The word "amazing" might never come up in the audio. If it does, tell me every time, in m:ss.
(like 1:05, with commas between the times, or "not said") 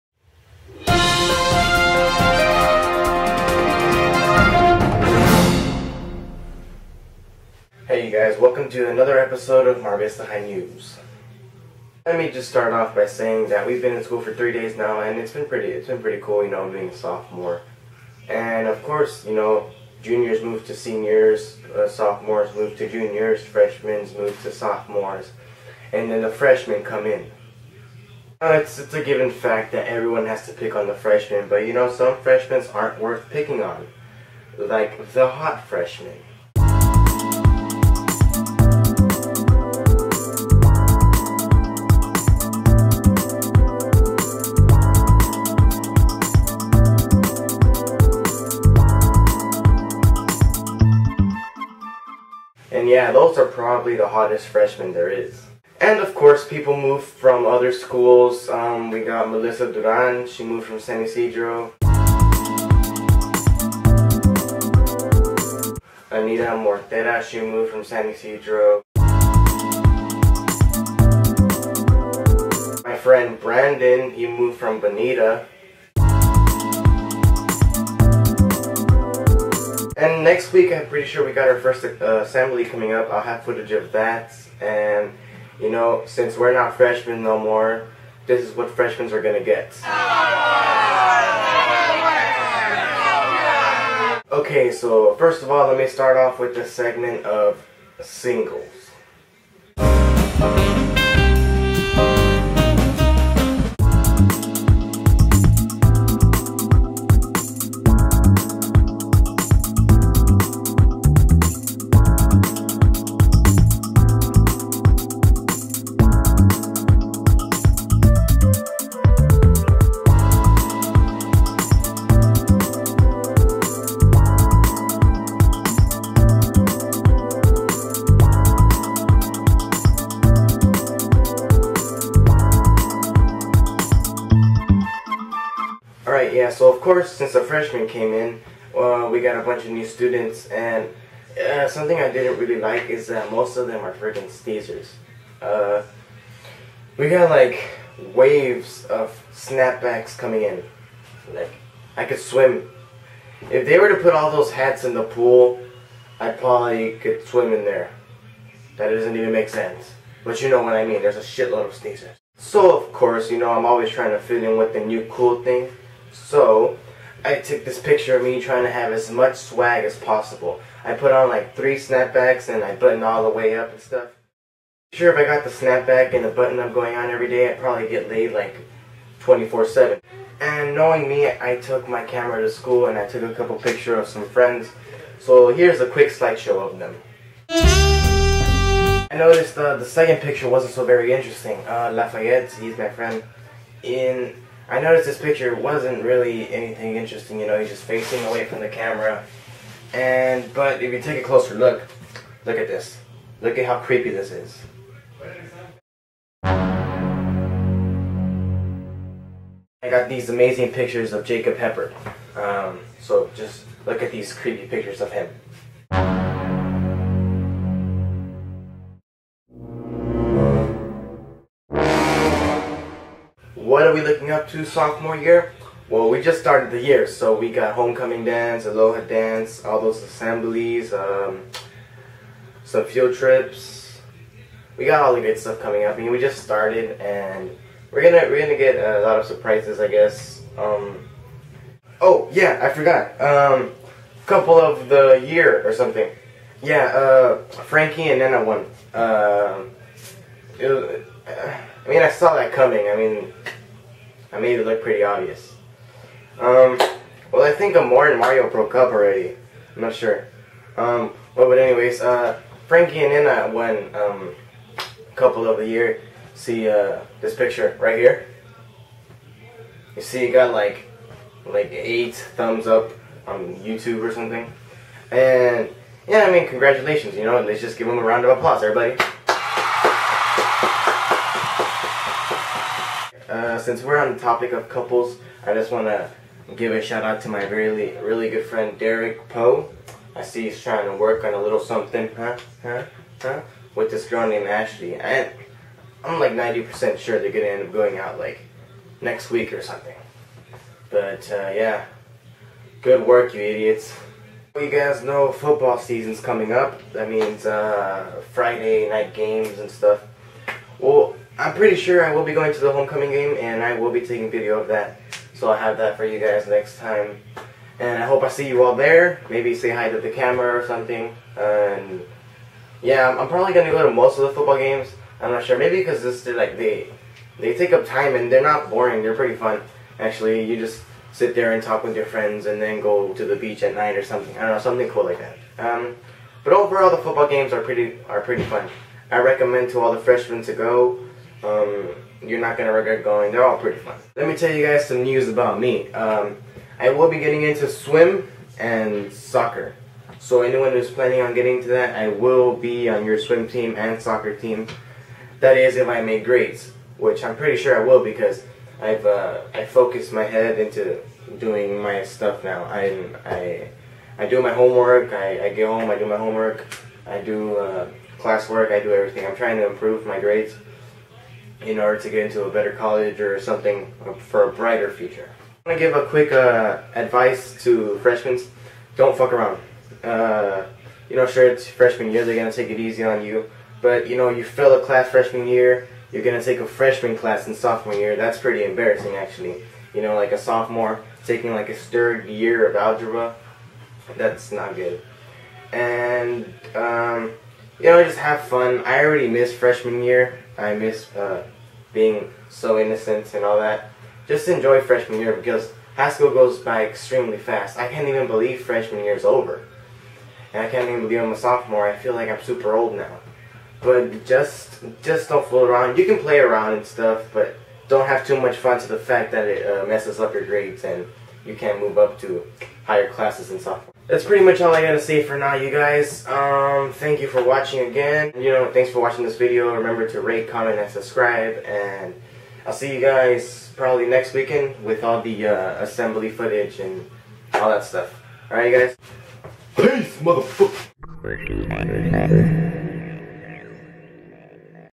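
3:30.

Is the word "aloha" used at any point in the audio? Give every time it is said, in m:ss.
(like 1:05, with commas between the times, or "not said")
3:48.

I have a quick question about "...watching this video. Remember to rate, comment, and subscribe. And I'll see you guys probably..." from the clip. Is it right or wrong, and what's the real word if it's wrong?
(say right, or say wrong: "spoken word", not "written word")
right.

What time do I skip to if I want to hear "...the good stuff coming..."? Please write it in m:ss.
3:55.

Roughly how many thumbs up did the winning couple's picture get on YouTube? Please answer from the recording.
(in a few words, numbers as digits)
8.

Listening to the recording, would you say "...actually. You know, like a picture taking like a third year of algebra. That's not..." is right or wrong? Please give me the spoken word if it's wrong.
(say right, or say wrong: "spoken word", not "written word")
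wrong: "sophomore", not "picture".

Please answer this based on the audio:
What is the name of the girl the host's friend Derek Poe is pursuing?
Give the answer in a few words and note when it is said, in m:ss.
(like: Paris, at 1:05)
Ashley, at 4:54.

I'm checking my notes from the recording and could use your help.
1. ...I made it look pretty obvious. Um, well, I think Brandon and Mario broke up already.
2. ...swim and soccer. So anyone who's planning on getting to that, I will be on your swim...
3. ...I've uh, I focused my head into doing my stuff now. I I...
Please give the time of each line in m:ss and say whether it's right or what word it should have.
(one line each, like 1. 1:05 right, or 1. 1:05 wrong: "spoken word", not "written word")
1. 4:14 wrong: "Amor", not "Brandon"
2. 5:47 right
3. 5:58 right.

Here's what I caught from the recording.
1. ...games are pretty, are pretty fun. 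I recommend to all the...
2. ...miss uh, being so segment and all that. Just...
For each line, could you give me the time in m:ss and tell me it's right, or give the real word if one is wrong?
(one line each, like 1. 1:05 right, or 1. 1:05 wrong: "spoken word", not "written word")
1. 5:37 right
2. 6:40 wrong: "innocent", not "segment".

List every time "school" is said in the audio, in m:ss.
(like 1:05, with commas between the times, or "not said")
0:14, 0:57, 3:02, 6:46.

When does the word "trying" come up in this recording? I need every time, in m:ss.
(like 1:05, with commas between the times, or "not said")
2:43, 2:48, 4:50, 6:09.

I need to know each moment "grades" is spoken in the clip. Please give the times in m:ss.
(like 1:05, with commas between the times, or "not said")
5:56, 6:10, 7:00.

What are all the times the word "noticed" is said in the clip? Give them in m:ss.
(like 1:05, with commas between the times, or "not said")
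3:09, 3:14.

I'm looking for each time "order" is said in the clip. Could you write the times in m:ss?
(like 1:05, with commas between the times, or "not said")
6:11.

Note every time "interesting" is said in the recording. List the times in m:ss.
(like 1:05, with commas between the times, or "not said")
3:11, 3:16.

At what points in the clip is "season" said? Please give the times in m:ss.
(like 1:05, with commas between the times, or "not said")
5:05.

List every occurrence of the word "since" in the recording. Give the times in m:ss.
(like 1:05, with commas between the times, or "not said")
1:26, 2:17, 4:43.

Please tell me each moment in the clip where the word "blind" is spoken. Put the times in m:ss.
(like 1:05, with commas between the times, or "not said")
not said.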